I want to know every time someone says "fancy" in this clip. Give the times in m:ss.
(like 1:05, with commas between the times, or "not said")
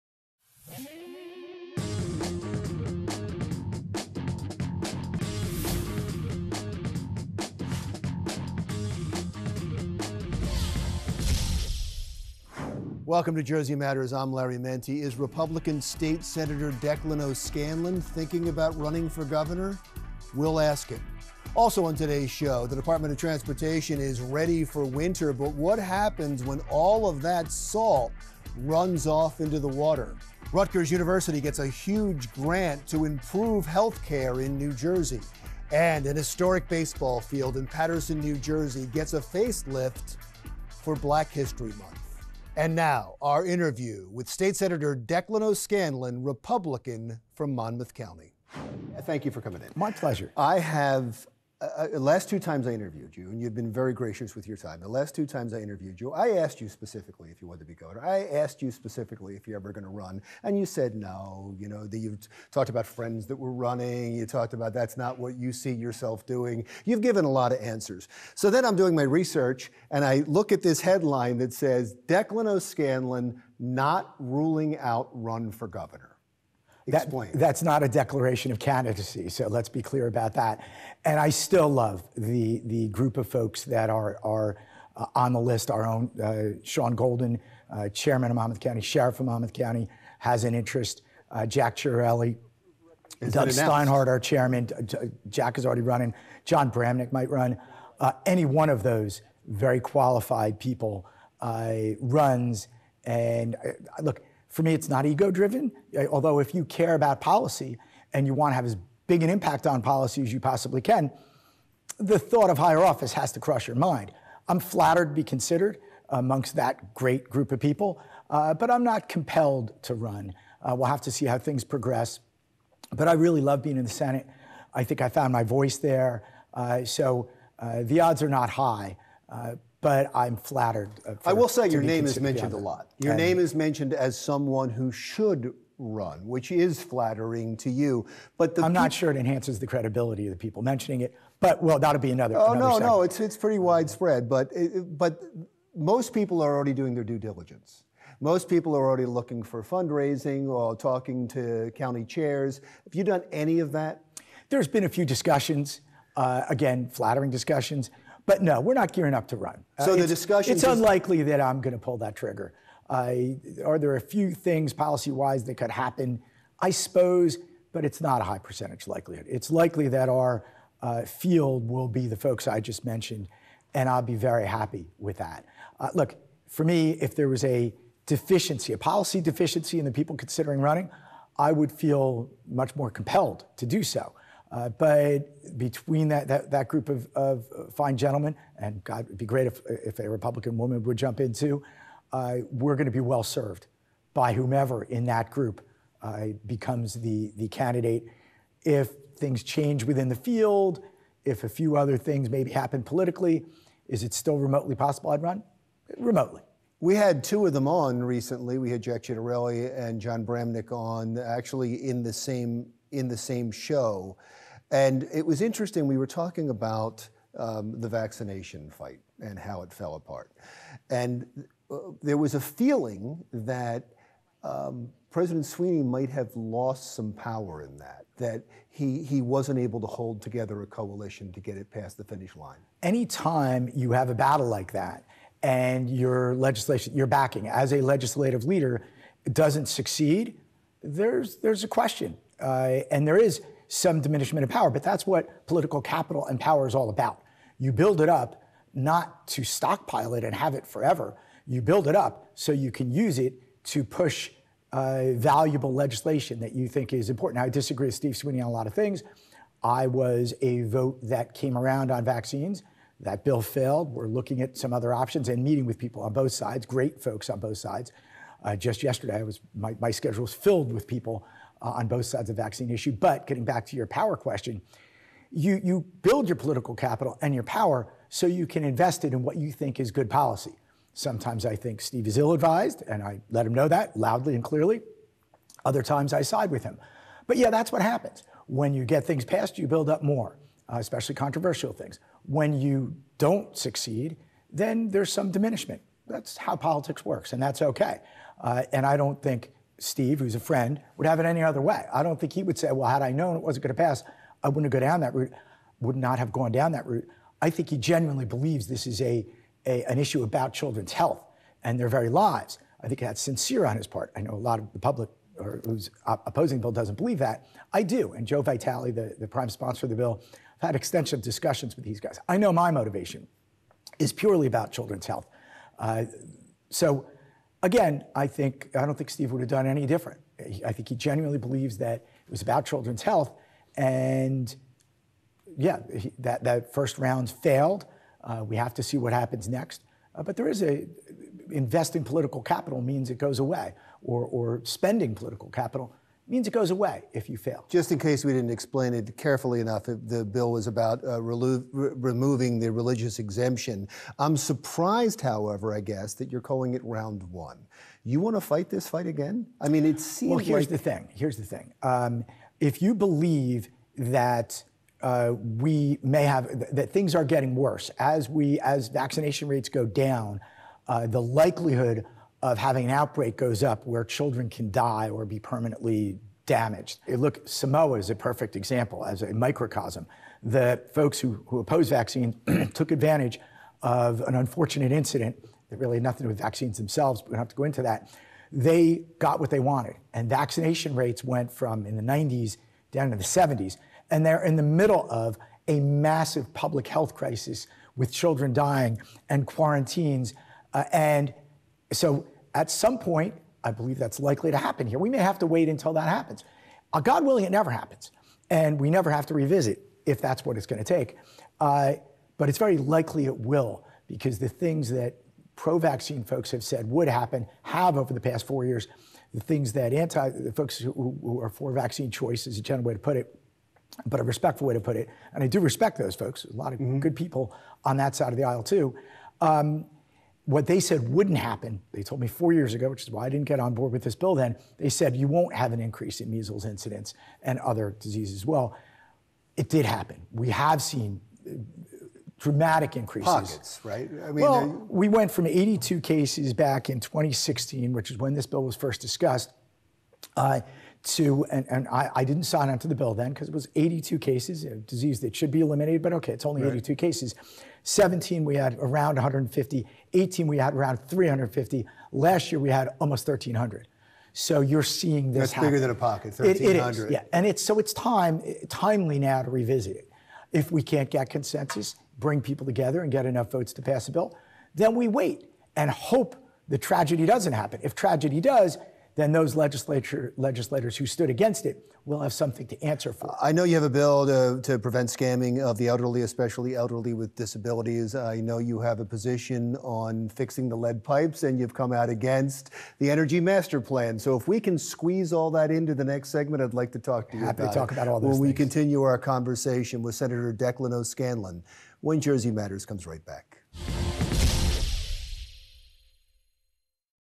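not said.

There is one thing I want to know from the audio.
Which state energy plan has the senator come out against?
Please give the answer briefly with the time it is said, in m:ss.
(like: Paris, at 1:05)
Energy Master Plan, at 8:13.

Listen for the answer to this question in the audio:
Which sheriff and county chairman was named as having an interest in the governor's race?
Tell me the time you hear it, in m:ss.
1:26.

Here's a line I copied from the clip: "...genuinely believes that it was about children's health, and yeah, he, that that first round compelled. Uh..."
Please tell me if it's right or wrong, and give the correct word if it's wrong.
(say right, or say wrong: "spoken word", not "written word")
wrong: "failed", not "compelled".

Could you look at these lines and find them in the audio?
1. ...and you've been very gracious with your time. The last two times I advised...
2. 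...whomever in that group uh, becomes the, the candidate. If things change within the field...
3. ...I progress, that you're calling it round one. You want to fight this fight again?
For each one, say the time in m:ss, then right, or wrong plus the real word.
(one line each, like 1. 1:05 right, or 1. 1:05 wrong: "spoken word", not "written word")
1. 0:53 wrong: "interviewed", not "advised"
2. 3:14 right
3. 5:55 wrong: "guess", not "progress".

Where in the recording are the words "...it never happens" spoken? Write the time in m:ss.
6:47.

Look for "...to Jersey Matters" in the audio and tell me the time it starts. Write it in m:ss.
0:13.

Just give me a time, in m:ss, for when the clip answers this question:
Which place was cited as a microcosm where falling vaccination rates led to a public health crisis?
6:17.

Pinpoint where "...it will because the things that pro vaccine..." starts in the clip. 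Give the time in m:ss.
6:53.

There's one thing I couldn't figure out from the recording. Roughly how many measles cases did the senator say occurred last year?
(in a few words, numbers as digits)
1,300.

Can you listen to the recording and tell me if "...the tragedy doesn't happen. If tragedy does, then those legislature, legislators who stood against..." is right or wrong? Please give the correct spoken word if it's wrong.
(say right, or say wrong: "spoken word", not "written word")
right.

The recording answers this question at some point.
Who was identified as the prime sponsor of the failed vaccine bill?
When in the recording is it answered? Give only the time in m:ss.
5:18.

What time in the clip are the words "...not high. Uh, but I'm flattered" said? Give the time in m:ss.
2:08.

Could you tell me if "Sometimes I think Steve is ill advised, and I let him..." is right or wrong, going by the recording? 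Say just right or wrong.
right.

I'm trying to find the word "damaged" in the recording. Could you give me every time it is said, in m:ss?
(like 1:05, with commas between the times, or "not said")
6:16.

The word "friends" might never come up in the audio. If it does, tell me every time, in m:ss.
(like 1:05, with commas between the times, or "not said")
1:02, 5:00.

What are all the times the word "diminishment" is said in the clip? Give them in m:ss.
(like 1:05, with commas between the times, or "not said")
4:04, 4:55.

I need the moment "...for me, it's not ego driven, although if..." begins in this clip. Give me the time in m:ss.
1:44.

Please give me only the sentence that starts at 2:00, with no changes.
Uh, we'll have to see how things progress.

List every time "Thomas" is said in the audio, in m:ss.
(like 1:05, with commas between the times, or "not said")
not said.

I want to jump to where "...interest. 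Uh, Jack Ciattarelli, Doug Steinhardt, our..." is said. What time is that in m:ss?
1:30.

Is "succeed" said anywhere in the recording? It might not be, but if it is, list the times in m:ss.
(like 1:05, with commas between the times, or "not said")
3:59, 4:53.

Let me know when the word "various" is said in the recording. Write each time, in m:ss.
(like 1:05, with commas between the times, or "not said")
not said.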